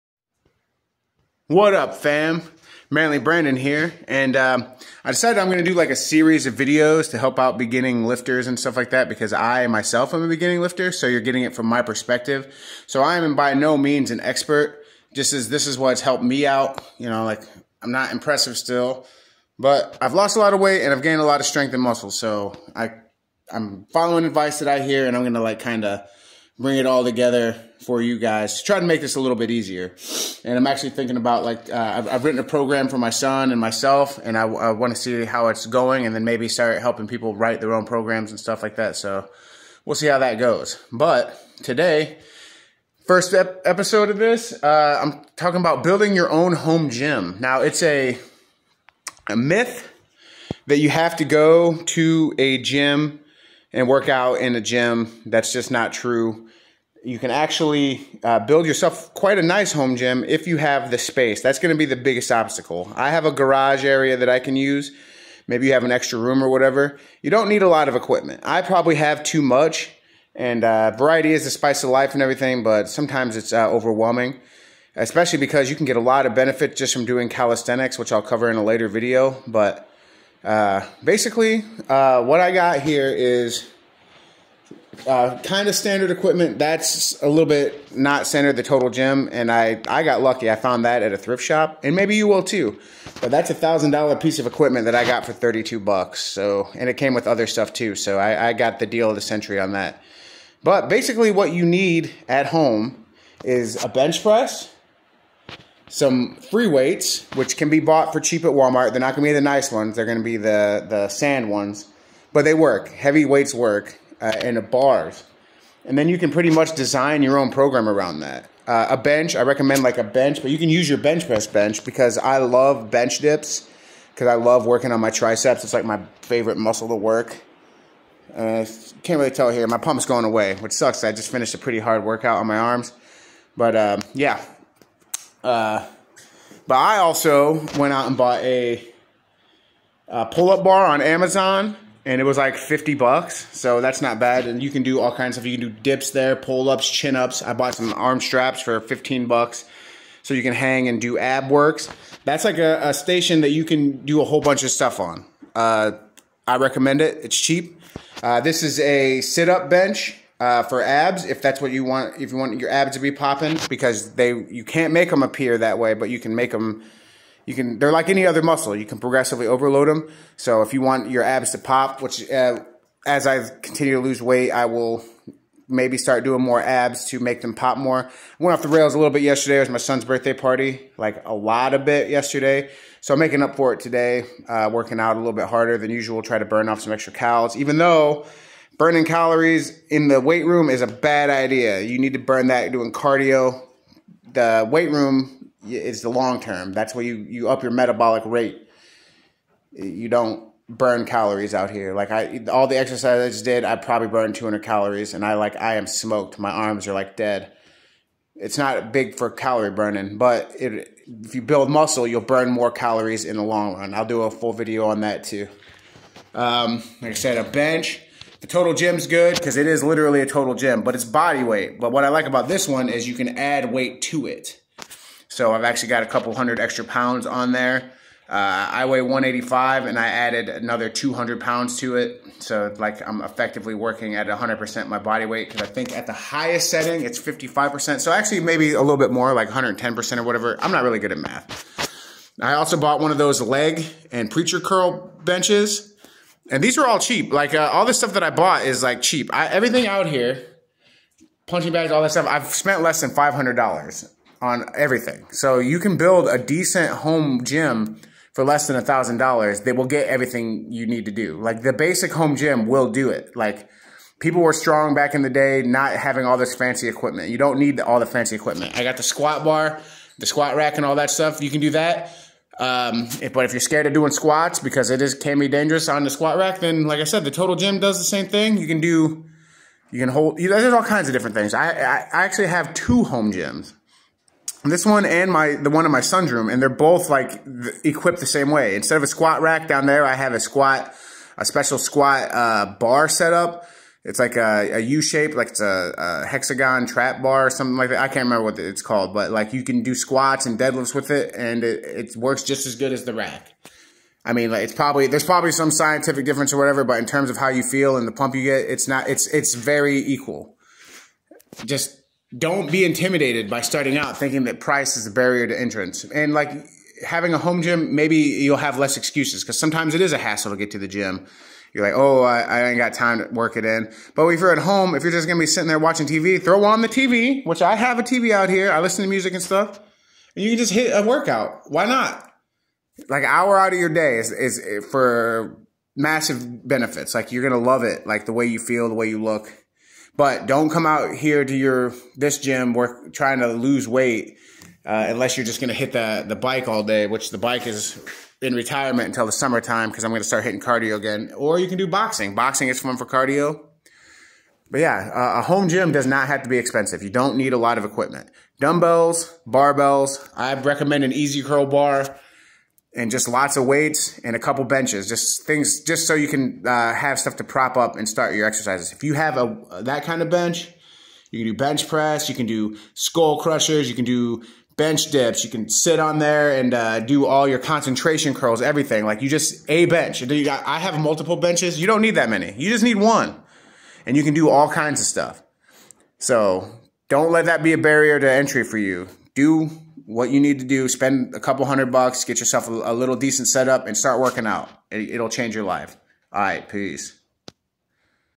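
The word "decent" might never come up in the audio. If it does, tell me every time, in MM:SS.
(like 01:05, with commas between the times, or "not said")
04:16, 06:33.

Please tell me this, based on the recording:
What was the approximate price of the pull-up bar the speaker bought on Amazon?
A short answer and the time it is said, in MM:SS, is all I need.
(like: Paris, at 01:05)
$50, at 02:22.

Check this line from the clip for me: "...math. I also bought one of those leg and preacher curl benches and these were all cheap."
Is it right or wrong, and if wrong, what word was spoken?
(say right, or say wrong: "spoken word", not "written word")
right.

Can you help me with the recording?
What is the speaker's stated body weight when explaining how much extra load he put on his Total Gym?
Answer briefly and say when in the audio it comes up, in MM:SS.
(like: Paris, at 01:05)
185, at 03:49.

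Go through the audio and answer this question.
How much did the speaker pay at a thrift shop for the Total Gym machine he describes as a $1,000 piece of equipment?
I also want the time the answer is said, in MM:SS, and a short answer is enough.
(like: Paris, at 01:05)
$32, at 01:35.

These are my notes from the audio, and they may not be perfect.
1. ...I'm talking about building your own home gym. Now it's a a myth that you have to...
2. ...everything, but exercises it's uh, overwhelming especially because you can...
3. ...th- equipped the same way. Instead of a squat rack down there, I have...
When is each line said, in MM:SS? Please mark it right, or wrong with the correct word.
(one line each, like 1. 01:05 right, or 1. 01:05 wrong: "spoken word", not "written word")
1. 00:45 right
2. 01:12 wrong: "sometimes", not "exercises"
3. 04:47 right.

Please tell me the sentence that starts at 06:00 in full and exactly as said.
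I recommend an EZ curl bar and just lots of weights and a couple benches.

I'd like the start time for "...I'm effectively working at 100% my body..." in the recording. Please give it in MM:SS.
03:53.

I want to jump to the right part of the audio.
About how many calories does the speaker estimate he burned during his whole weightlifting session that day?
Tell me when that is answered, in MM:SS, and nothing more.
03:24.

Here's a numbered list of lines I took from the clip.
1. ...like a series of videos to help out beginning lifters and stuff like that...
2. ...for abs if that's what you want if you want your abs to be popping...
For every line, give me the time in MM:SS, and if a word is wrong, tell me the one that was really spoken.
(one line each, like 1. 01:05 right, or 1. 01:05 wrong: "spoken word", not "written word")
1. 00:05 right
2. 02:40 right.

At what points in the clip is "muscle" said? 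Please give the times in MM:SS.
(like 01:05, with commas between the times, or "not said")
00:21, 02:06, 02:48, 03:31.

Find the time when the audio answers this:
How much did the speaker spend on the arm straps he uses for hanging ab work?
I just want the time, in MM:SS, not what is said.
02:28.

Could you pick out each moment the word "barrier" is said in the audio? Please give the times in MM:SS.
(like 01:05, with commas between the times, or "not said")
05:15, 06:27.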